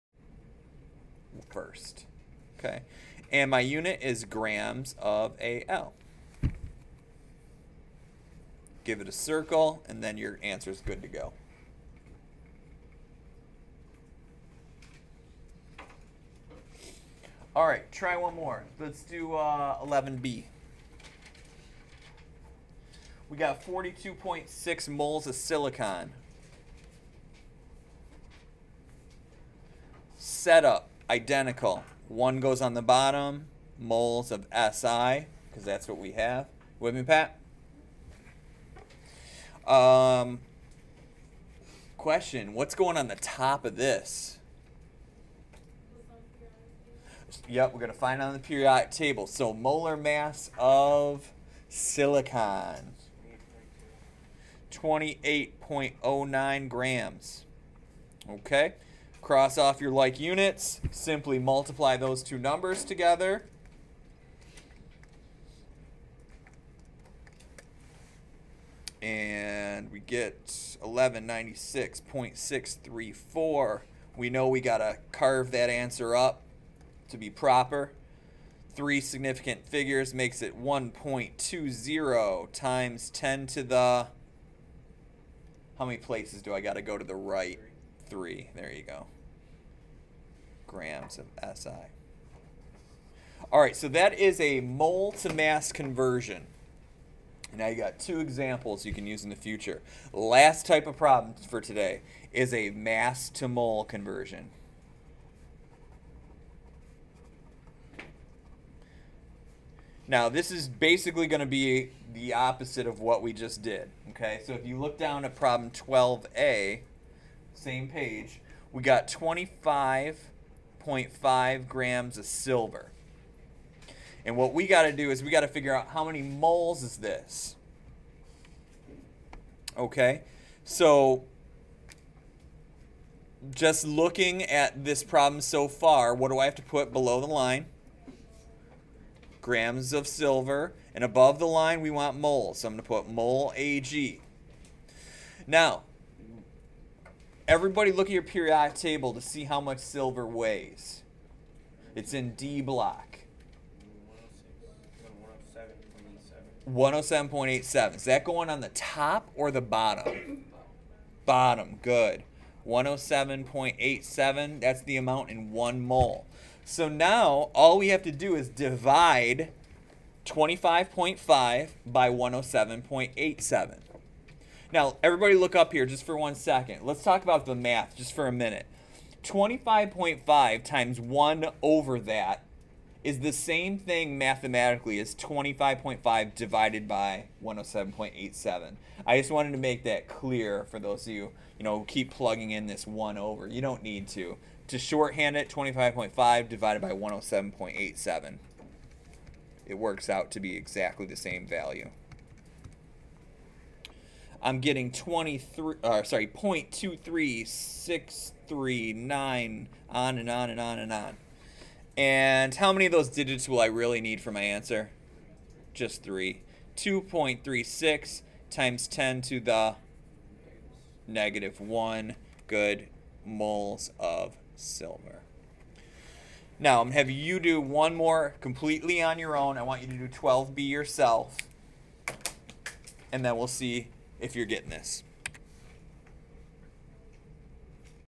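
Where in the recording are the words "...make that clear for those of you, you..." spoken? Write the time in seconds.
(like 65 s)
189 s.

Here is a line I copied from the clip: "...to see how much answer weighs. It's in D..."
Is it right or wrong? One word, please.
wrong.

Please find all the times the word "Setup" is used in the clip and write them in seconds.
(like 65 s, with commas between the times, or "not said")
30 s.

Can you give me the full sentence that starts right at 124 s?
And what we got to do is we got to figure out how many moles is this.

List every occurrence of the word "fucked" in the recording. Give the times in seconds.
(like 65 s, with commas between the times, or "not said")
not said.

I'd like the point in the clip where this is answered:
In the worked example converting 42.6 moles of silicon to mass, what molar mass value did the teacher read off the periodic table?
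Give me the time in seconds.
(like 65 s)
54 s.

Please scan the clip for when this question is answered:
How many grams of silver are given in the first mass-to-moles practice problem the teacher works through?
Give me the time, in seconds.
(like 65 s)
119 s.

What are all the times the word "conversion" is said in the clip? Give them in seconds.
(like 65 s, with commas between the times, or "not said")
95 s, 103 s.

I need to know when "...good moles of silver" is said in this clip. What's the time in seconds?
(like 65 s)
222 s.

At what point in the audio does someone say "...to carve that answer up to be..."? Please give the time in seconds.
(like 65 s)
74 s.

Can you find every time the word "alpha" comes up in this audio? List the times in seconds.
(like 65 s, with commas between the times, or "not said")
not said.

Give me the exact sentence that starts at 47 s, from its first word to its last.
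Yep, we're going to find on the periodic table.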